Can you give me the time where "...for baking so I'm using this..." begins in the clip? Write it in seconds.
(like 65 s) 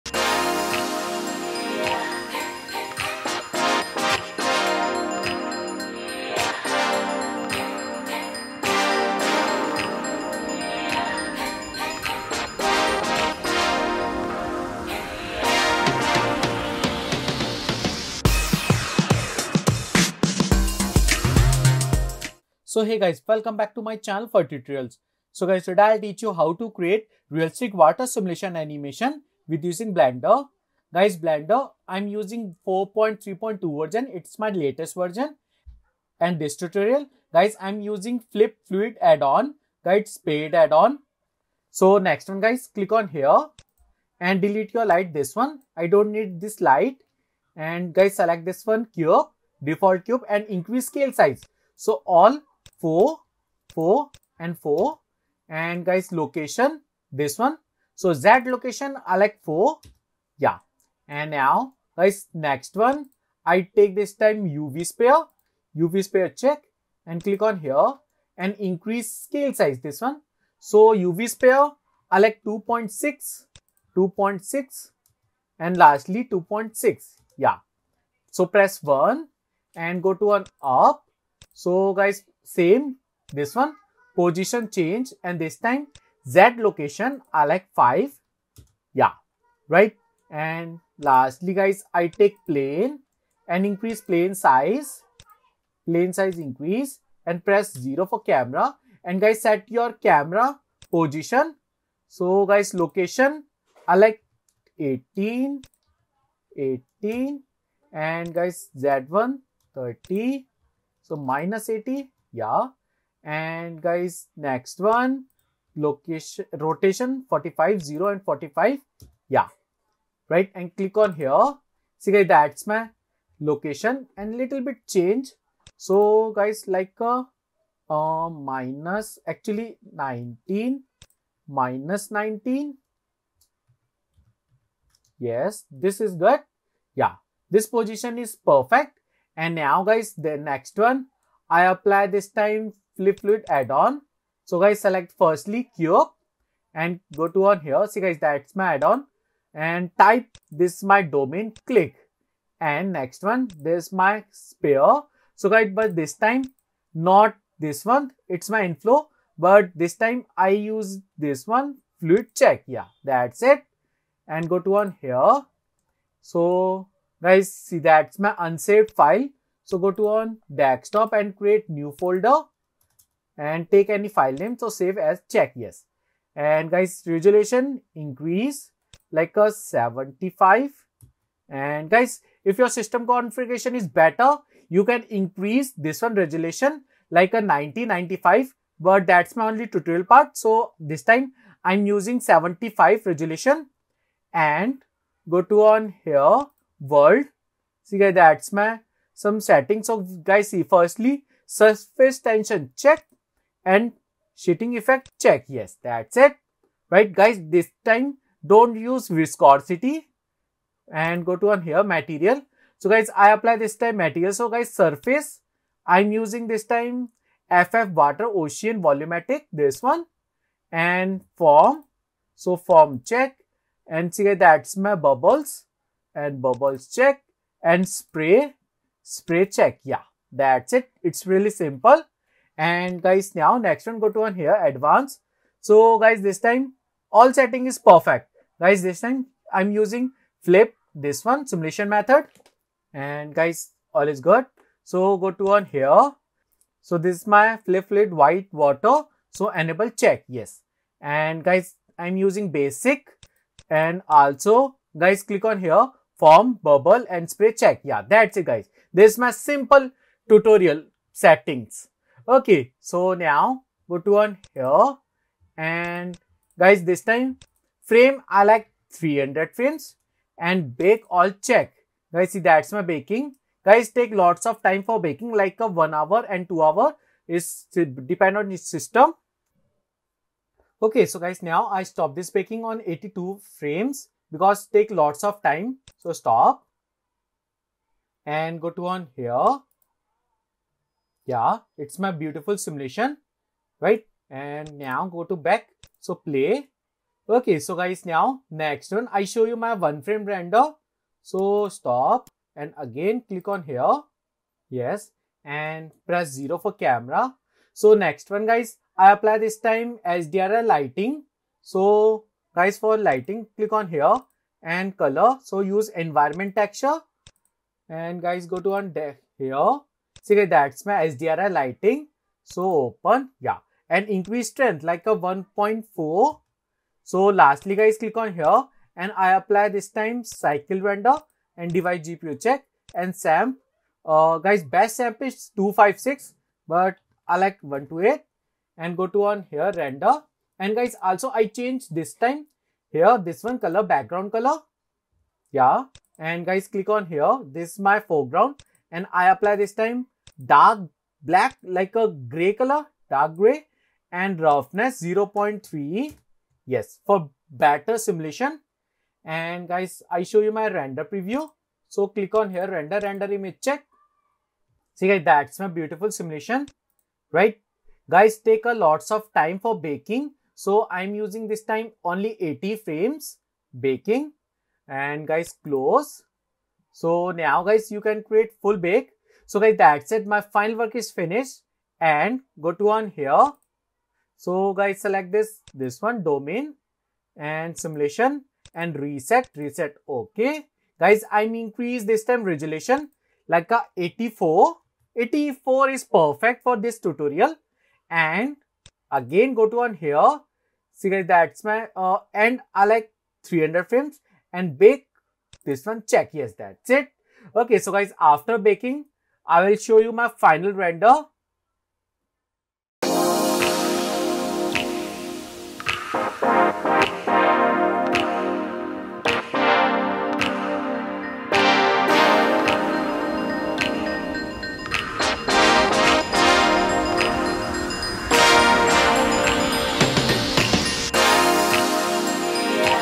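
369 s.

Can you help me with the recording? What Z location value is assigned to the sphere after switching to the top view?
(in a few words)
5.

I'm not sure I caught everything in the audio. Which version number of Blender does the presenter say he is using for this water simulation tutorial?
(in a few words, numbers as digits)
4.3.2.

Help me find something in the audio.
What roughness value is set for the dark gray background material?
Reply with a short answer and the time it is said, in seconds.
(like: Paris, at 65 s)
0.3, at 355 s.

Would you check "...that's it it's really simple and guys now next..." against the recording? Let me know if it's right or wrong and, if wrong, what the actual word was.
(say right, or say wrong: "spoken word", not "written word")
right.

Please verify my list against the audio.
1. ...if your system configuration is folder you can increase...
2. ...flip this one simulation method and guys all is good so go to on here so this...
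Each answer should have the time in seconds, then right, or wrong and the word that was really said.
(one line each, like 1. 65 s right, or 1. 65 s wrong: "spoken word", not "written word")
1. 182 s wrong: "better", not "folder"
2. 240 s right.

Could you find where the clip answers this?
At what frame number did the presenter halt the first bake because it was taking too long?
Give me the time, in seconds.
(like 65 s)
282 s.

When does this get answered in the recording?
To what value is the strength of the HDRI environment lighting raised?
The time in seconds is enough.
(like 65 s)
325 s.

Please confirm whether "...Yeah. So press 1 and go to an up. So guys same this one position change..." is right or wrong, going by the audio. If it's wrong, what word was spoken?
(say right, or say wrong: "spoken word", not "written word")
right.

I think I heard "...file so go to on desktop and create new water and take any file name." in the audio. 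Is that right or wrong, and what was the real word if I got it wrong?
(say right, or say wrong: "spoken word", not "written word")
wrong: "folder", not "water".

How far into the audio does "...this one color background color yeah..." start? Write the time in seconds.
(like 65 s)
343 s.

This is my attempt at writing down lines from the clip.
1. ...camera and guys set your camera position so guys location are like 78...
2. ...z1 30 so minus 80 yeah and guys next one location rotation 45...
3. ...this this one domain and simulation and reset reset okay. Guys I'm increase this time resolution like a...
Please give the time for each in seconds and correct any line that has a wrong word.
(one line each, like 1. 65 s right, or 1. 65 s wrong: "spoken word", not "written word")
1. 98 s wrong: "18", not "78"
2. 108 s right
3. 385 s right.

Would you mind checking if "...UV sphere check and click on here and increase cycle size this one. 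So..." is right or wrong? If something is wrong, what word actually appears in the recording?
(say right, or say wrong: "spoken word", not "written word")
wrong: "scale", not "cycle".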